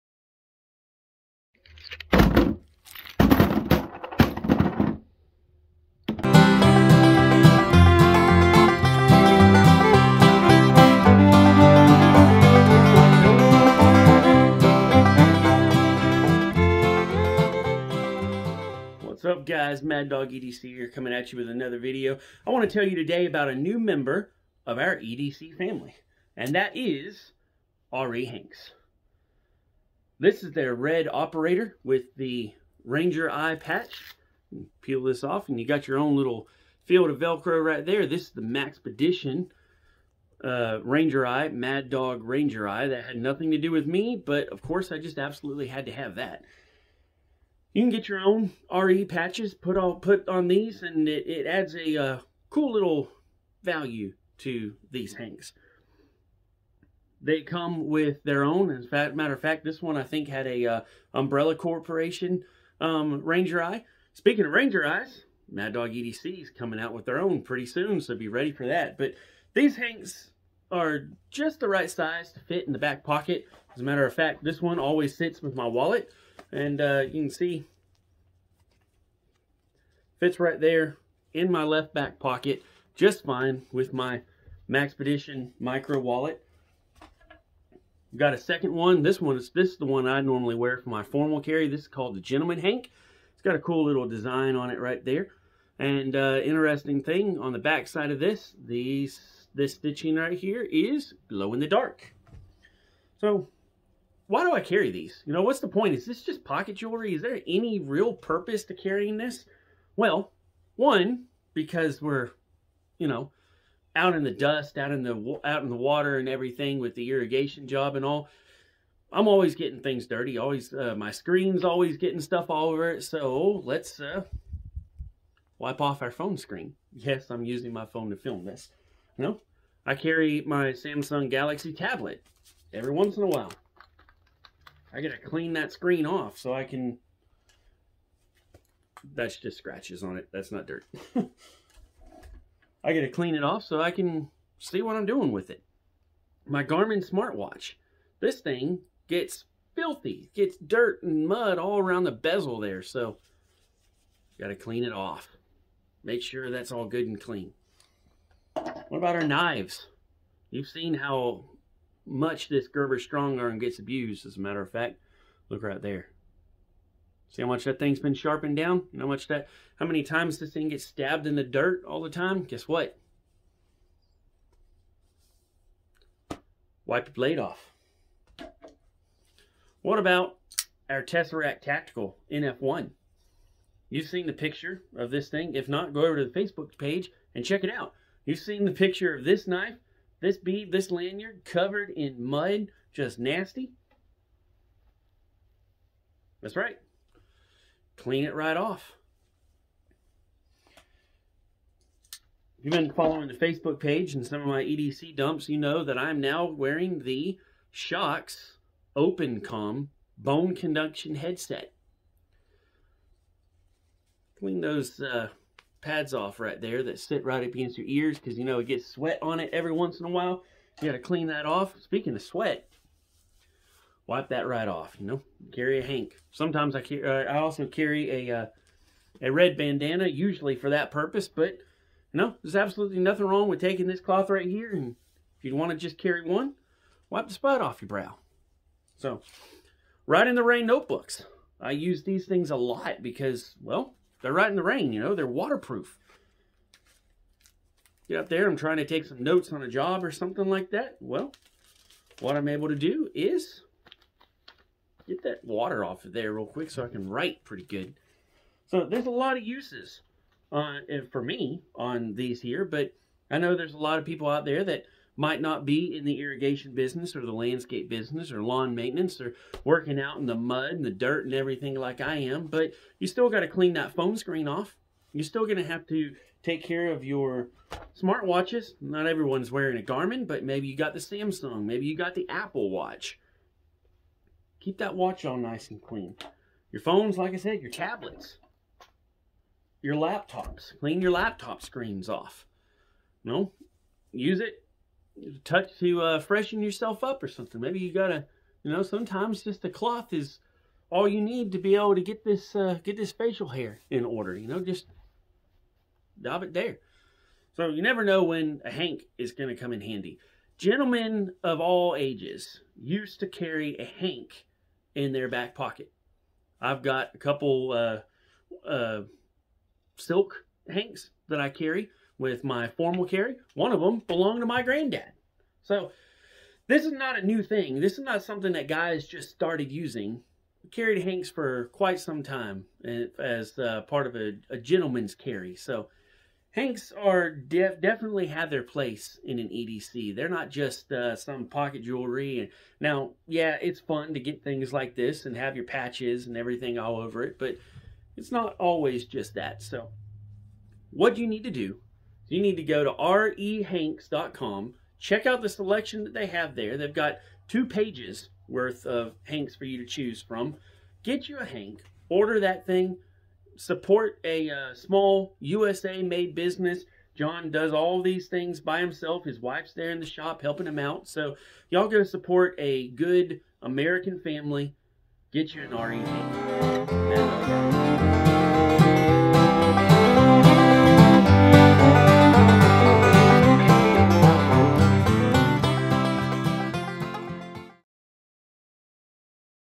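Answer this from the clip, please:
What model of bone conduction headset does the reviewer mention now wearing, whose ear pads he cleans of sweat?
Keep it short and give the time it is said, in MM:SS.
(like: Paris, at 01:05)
Shokz OpenComm, at 03:27.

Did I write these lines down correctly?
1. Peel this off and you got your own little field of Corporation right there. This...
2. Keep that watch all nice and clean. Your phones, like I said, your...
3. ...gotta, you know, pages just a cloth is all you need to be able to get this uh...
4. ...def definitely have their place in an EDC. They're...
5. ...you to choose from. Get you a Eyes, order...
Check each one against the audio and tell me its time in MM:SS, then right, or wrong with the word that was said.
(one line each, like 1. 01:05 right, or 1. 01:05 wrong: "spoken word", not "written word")
1. 00:34 wrong: "Velcro", not "Corporation"
2. 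04:44 right
3. 04:57 wrong: "sometimes", not "pages"
4. 05:37 right
5. 05:59 wrong: "Hank", not "Eyes".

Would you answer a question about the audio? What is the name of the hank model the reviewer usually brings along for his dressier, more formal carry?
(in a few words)
Gentleman Hank.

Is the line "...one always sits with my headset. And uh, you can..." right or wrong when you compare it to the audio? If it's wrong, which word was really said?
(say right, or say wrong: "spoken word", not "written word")
wrong: "wallet", not "headset".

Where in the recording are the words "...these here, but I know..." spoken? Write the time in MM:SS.
04:22.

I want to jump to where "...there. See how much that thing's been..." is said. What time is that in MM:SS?
02:45.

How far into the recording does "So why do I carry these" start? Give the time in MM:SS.
01:43.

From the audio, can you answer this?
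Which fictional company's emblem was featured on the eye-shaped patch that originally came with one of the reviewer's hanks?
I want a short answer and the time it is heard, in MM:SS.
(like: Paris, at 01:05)
Umbrella Corporation, at 01:01.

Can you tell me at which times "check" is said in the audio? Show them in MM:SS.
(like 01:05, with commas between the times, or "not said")
03:07, 05:54.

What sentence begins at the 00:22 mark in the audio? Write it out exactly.
I want to tell you today about a new member of our EDC family, and that is R.E.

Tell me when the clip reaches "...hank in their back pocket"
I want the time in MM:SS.
05:13.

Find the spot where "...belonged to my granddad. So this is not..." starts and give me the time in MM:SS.
05:24.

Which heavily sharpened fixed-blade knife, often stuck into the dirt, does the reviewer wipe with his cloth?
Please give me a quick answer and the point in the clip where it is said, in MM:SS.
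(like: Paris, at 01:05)
Gerber StrongArm, at 02:42.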